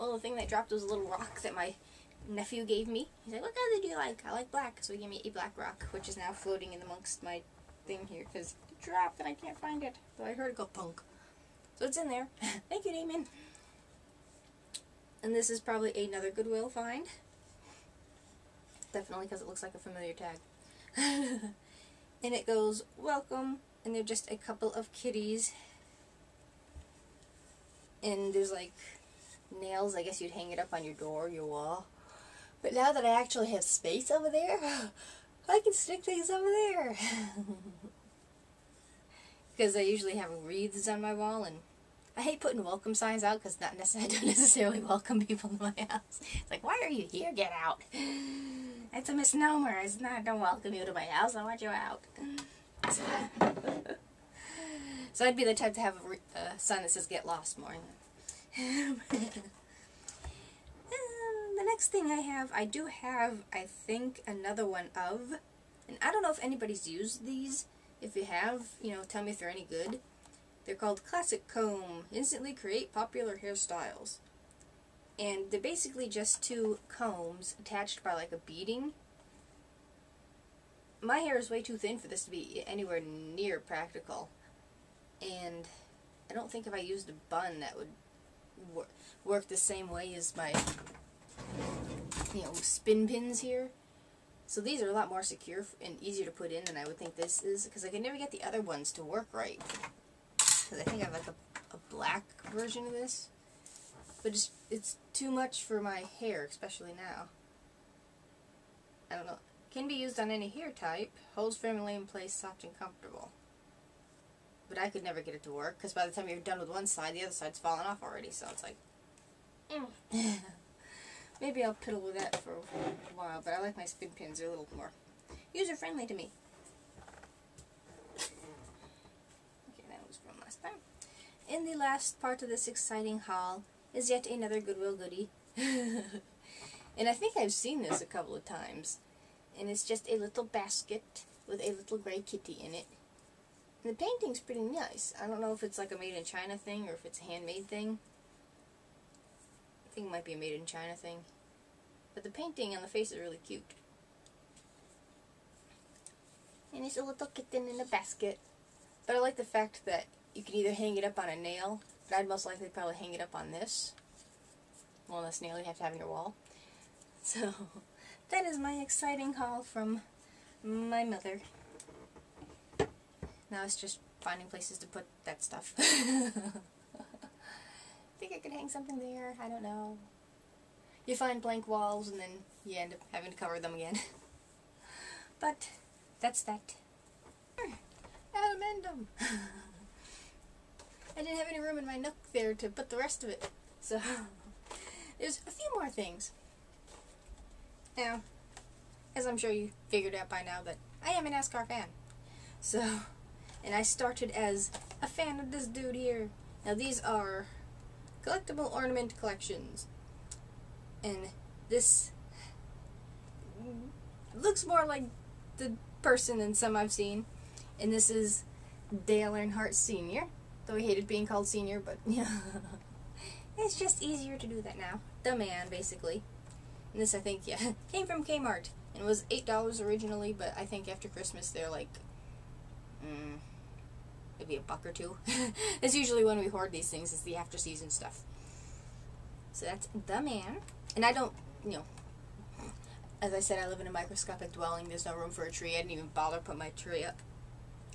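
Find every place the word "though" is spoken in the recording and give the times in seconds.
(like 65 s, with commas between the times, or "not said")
10 s, 220 s.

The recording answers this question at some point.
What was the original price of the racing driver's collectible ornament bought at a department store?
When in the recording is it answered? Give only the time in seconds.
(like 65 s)
229 s.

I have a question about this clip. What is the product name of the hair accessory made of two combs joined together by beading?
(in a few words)
Classic Comb.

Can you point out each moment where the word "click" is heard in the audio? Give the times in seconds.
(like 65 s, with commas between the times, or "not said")
not said.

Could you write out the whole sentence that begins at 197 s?
Now, as I'm sure you figured out by now, but I am an NASCAR fan.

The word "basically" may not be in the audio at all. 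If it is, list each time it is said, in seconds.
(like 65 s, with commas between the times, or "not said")
75 s, 225 s.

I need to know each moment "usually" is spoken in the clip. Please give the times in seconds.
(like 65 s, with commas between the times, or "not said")
39 s, 235 s.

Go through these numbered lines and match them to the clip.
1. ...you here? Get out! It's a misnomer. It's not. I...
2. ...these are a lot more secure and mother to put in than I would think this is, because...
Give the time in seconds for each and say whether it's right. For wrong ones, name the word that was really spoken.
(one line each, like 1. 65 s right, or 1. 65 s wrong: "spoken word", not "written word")
1. 46 s right
2. 94 s wrong: "easier", not "mother".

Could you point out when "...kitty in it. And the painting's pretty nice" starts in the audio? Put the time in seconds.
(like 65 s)
142 s.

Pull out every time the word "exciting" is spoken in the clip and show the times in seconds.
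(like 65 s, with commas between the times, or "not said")
132 s, 168 s.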